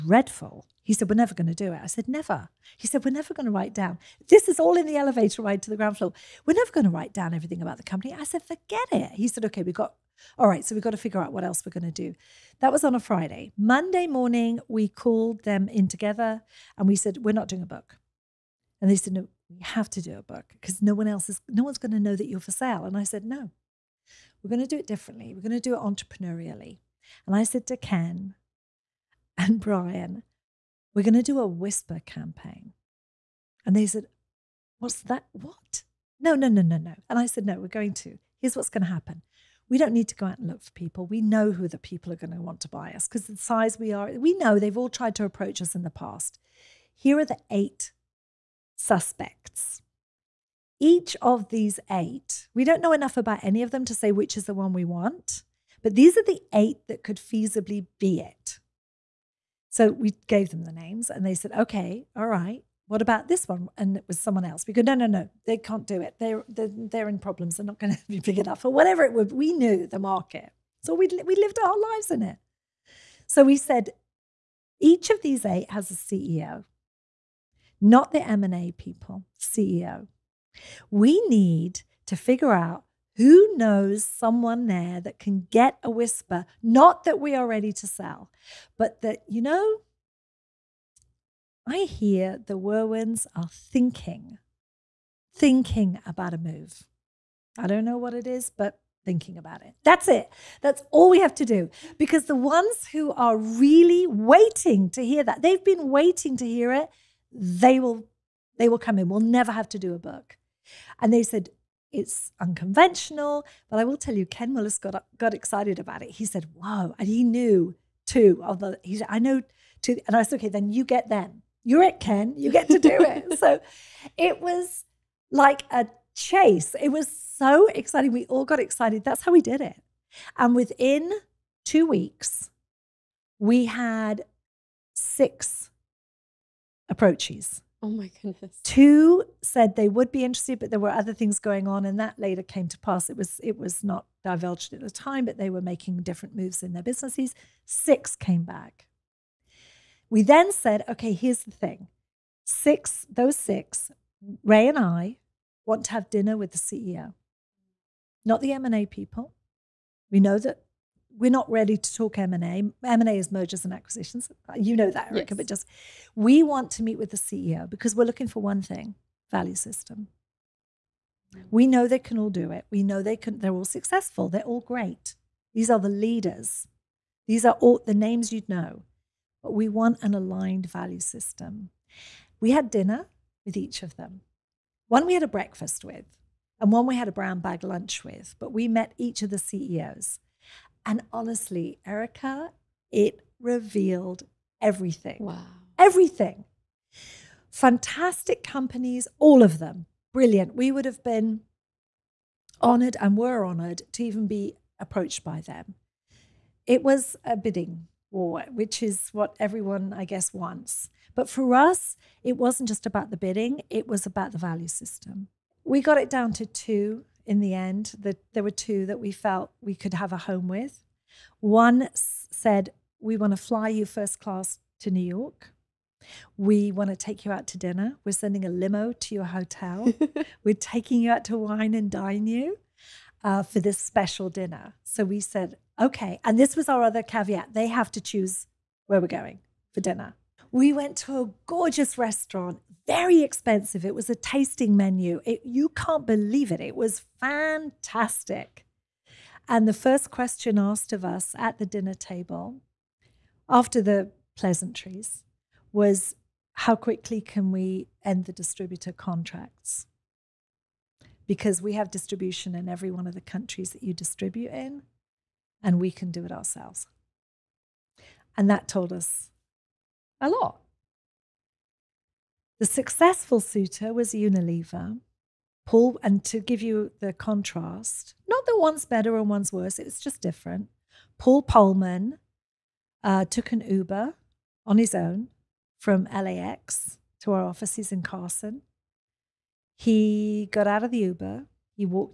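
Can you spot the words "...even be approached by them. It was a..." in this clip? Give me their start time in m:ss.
3:24.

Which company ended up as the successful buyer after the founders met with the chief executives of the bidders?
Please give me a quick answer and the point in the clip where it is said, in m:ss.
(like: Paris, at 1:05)
Unilever, at 4:34.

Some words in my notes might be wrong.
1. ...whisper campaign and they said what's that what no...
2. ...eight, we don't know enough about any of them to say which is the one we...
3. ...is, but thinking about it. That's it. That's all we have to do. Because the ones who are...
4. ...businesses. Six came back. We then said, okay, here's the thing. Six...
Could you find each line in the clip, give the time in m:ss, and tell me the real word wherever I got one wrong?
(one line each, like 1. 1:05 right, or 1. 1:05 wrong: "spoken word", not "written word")
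1. 0:31 right
2. 0:51 right
3. 1:38 right
4. 2:26 right.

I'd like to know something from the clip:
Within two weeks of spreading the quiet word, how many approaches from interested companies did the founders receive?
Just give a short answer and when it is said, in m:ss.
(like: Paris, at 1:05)
6, at 2:14.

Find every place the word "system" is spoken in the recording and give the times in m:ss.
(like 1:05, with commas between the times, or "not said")
2:49, 3:00, 3:34.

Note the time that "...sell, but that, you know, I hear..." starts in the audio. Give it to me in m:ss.
1:27.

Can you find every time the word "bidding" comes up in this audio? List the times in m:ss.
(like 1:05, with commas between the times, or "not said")
3:27, 3:33.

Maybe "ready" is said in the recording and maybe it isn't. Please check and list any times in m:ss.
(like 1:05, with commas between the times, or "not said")
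1:27, 2:41.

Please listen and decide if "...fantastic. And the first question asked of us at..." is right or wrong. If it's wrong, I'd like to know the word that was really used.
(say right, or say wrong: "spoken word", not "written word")
right.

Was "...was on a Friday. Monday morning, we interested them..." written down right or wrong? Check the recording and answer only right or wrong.
wrong.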